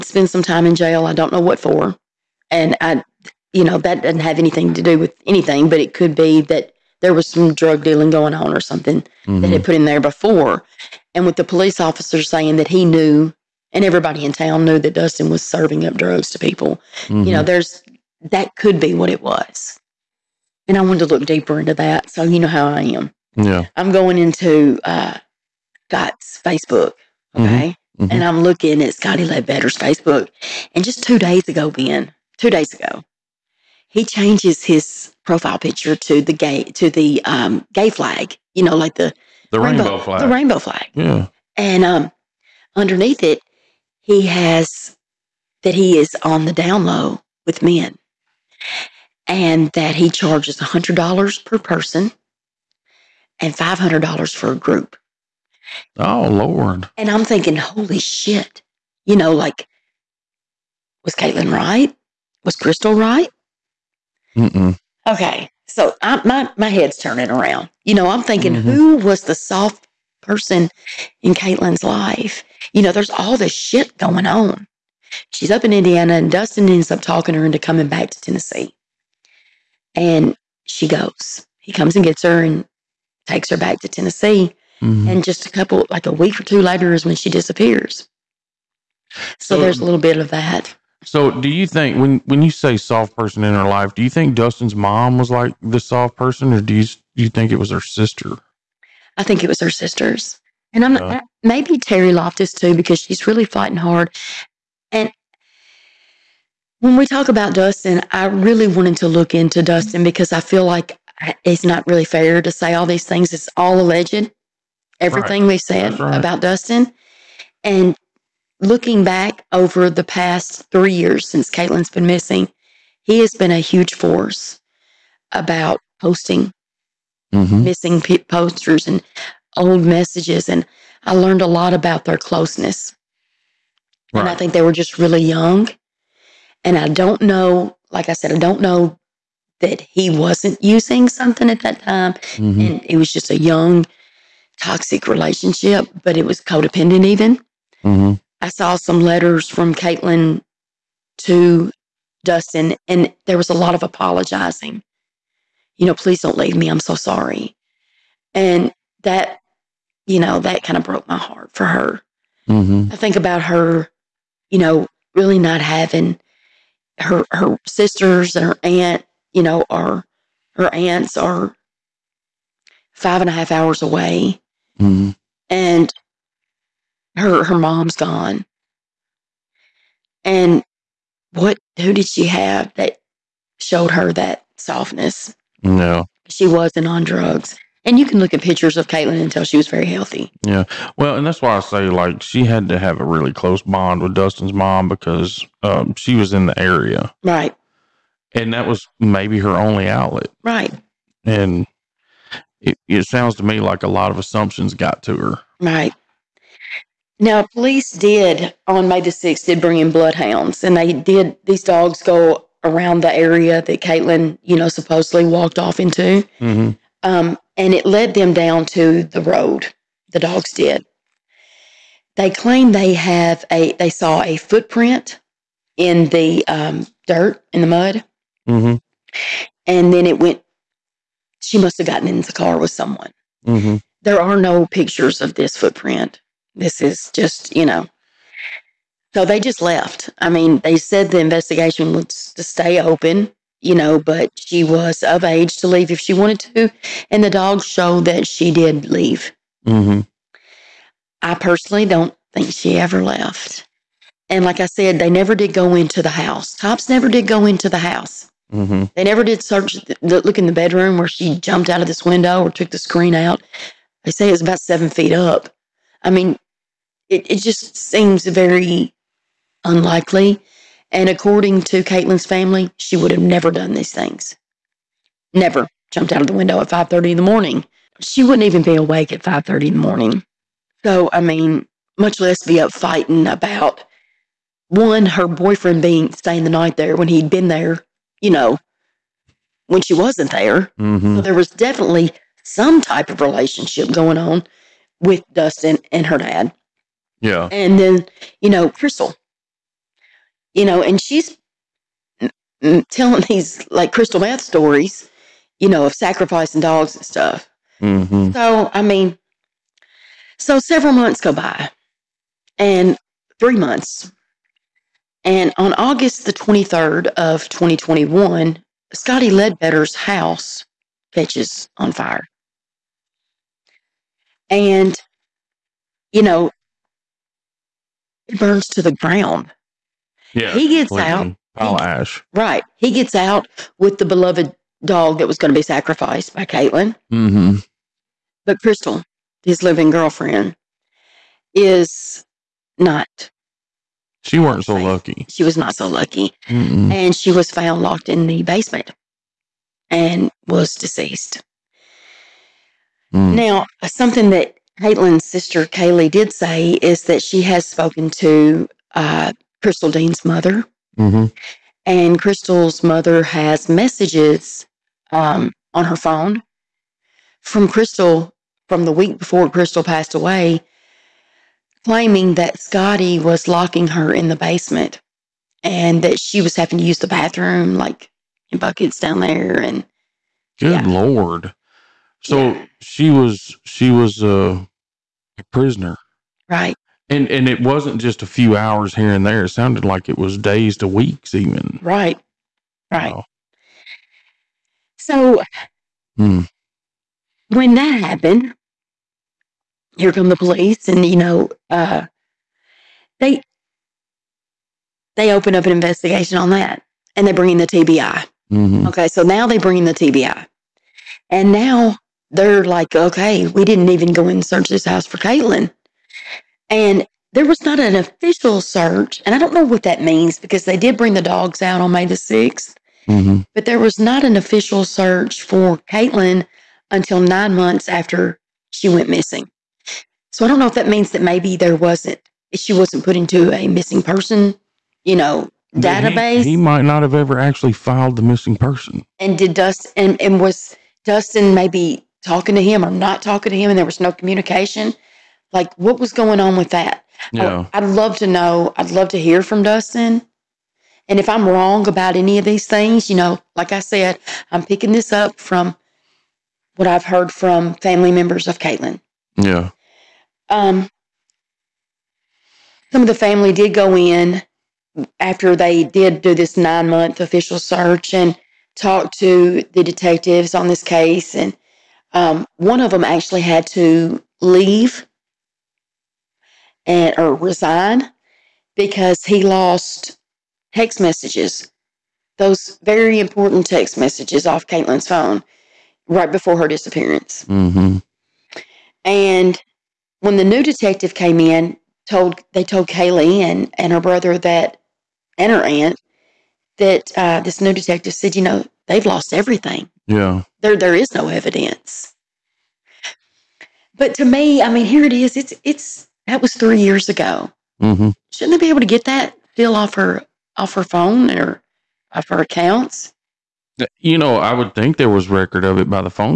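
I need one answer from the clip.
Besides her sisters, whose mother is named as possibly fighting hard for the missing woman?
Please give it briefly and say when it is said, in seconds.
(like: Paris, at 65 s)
Terry Loftus, at 101 s.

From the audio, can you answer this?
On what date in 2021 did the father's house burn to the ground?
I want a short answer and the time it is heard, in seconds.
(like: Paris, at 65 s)
August 23, at 315 s.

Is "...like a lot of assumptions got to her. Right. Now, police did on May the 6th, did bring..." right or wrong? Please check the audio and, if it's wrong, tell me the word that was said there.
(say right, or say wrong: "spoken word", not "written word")
right.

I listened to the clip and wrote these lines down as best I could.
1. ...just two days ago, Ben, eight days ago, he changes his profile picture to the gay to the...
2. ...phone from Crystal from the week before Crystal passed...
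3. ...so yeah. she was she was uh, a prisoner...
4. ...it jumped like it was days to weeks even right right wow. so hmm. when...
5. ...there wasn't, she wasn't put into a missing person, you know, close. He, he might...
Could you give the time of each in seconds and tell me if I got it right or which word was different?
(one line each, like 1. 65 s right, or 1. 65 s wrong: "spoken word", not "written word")
1. 30 s wrong: "two", not "eight"
2. 365 s right
3. 382 s right
4. 389 s wrong: "sounded", not "jumped"
5. 431 s wrong: "database", not "close".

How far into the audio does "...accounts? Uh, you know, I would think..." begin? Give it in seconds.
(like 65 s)
512 s.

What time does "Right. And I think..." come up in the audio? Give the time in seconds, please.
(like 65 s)
134 s.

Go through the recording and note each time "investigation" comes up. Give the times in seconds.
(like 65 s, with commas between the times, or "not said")
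241 s, 405 s.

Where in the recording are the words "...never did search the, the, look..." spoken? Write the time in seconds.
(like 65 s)
259 s.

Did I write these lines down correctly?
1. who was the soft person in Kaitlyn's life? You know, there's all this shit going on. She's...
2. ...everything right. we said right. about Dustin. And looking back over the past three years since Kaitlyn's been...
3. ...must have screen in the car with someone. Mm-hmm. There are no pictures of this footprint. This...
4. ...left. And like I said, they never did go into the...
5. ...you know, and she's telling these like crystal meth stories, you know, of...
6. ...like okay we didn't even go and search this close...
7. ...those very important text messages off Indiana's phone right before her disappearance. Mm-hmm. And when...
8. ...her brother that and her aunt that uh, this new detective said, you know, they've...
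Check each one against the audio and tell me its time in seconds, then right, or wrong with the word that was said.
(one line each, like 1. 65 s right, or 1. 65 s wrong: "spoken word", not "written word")
1. 68 s right
2. 115 s right
3. 231 s wrong: "gotten", not "screen"
4. 253 s right
5. 300 s right
6. 412 s wrong: "house", not "close"
7. 482 s wrong: "Kaitlyn", not "Indiana"
8. 493 s right.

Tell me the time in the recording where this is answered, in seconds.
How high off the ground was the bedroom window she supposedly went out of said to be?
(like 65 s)
264 s.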